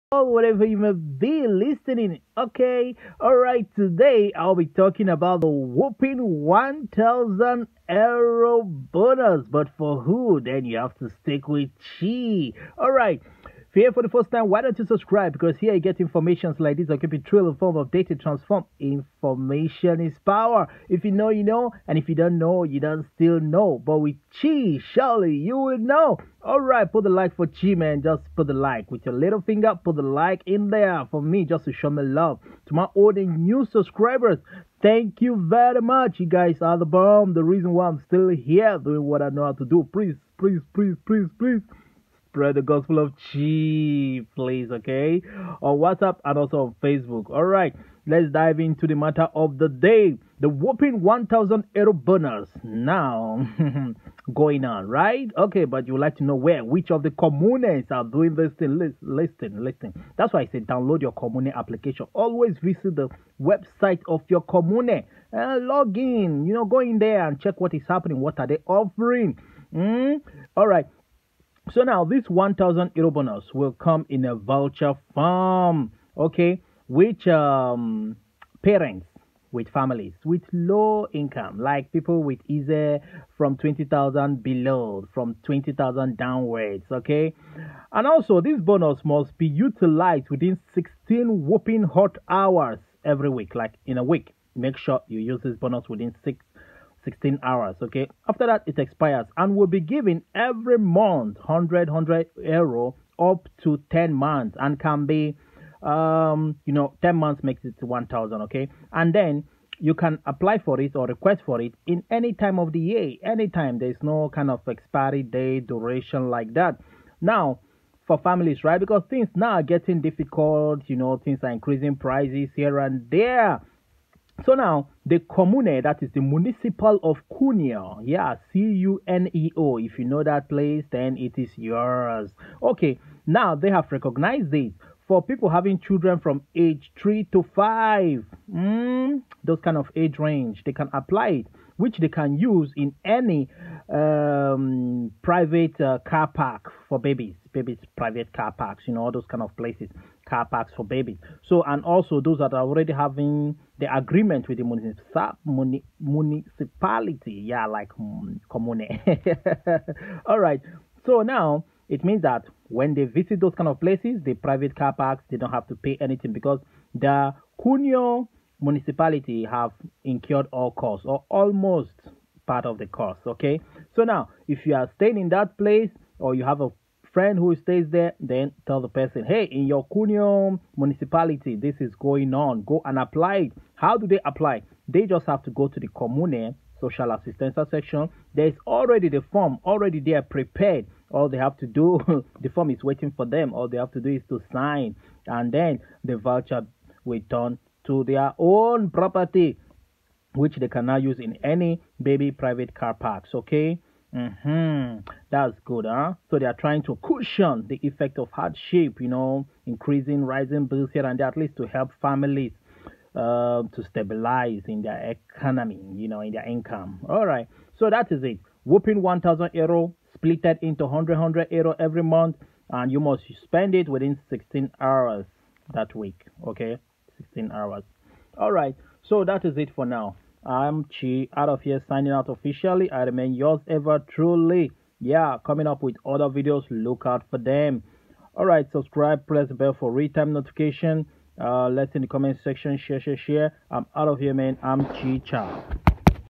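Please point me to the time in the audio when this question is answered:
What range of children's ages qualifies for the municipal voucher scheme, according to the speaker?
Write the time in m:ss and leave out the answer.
2:16.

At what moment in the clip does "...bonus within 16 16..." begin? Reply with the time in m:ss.
1:35.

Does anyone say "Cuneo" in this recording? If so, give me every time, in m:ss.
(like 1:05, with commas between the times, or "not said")
2:07, 2:47, 2:59.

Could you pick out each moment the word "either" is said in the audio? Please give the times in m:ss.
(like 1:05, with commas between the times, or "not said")
1:22.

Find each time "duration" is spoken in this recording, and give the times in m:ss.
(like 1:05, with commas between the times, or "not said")
1:55.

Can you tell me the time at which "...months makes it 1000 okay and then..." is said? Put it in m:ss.
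1:47.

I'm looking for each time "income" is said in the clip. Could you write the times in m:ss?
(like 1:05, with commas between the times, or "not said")
1:21, 3:36.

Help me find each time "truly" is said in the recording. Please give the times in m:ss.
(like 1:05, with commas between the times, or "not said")
0:17, 3:53.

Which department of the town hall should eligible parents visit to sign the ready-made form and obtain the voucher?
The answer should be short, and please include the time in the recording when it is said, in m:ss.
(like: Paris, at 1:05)
social assistance section, at 3:06.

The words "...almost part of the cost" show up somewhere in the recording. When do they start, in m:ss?
2:51.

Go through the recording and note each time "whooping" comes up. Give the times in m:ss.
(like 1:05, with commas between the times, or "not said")
0:05, 1:31, 3:38.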